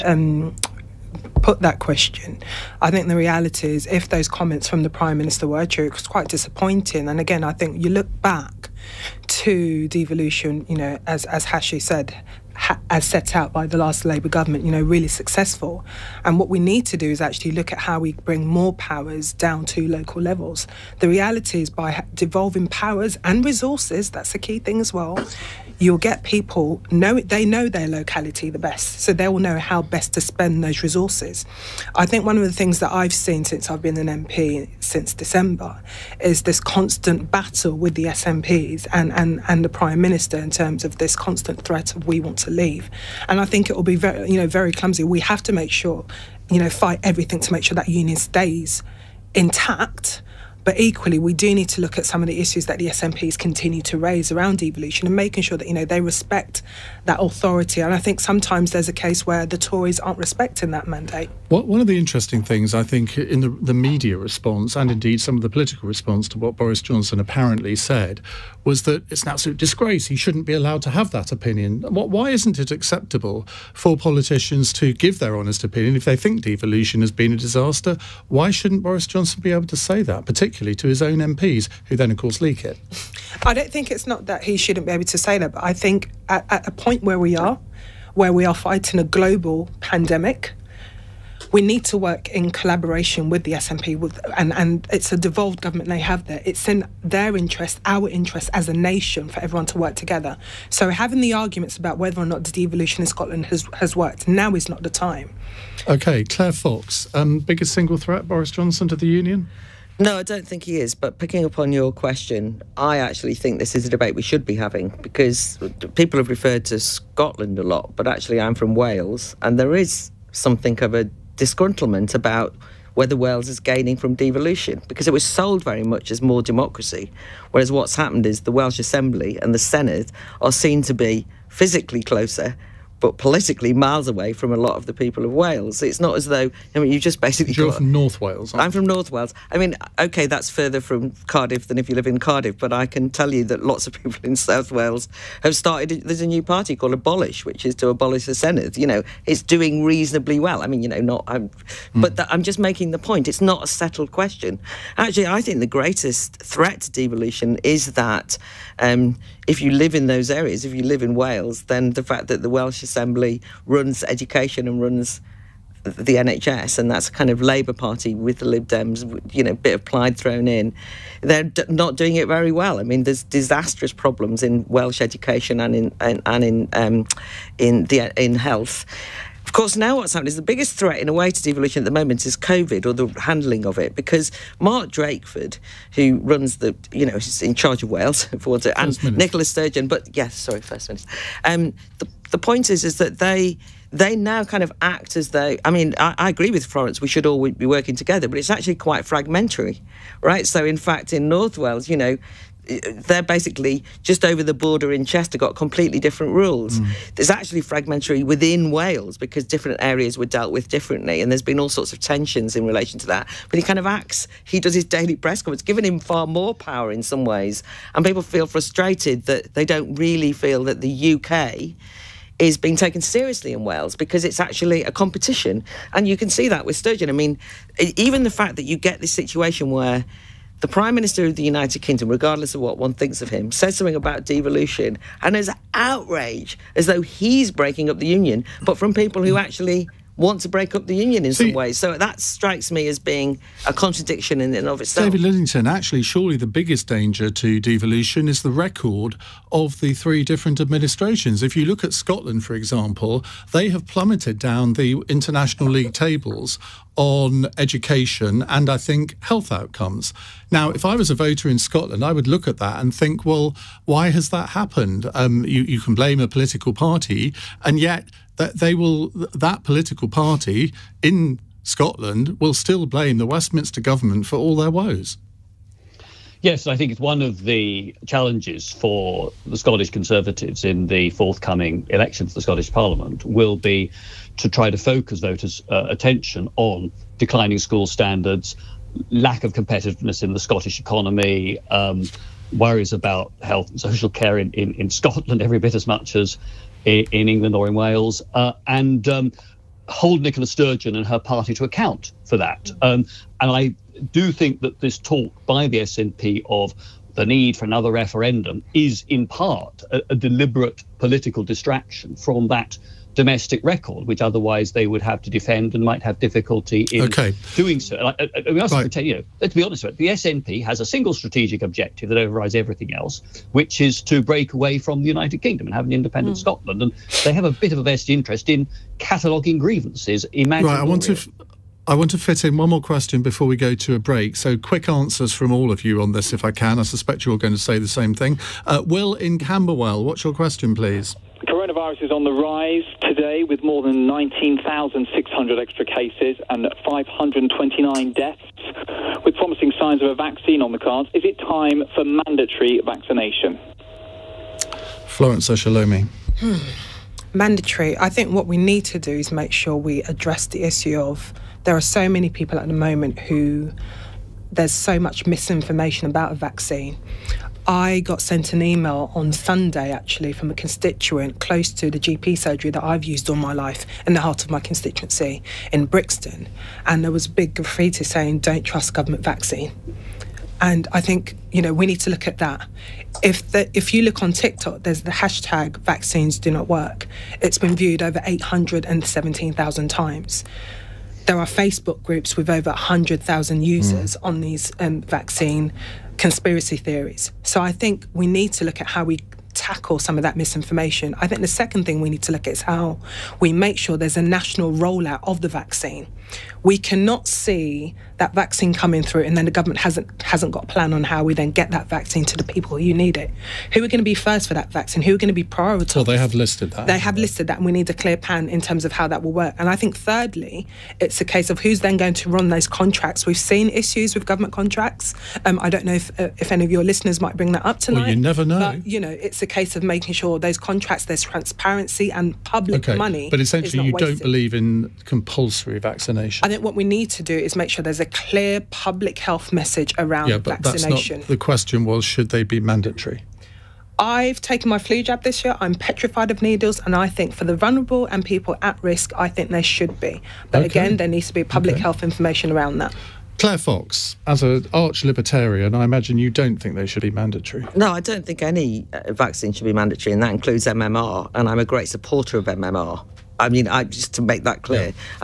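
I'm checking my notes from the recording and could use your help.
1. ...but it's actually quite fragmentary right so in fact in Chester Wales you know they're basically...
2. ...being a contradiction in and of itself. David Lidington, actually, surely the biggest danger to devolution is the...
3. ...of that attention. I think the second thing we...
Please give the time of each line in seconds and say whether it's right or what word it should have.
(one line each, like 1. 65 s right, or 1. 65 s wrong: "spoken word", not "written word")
1. 198 s wrong: "North", not "Chester"
2. 242 s right
3. 400 s wrong: "misinformation", not "attention".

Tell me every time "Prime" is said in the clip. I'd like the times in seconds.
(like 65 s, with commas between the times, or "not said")
4 s, 39 s, 230 s.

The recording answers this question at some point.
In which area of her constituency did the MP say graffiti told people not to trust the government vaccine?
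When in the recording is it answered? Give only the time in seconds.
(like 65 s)
375 s.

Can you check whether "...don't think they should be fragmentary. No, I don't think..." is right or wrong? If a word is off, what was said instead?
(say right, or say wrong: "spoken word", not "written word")
wrong: "mandatory", not "fragmentary".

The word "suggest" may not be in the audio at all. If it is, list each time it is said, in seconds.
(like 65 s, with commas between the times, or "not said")
not said.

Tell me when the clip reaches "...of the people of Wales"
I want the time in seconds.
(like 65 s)
134 s.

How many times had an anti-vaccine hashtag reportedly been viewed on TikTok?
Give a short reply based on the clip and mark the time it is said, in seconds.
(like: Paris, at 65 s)
817,000, at 388 s.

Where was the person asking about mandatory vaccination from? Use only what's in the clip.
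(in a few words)
Camberwell.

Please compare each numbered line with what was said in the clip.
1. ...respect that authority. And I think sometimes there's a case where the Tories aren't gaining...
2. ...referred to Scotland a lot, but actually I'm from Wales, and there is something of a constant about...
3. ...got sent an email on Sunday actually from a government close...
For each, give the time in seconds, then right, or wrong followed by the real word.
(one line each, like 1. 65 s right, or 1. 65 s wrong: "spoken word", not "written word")
1. 56 s wrong: "respecting", not "gaining"
2. 116 s wrong: "disgruntlement", not "constant"
3. 368 s wrong: "constituent", not "government".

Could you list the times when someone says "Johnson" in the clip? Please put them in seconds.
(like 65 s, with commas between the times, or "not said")
66 s, 79 s, 108 s.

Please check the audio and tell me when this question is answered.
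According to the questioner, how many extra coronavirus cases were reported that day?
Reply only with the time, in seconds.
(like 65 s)
344 s.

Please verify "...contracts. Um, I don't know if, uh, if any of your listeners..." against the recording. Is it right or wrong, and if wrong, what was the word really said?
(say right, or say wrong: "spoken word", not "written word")
right.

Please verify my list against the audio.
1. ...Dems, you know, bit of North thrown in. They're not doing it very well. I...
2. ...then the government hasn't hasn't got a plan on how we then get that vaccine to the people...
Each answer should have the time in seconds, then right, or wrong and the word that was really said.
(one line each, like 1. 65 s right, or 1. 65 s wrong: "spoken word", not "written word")
1. 168 s wrong: "Plaid", not "North"
2. 409 s right.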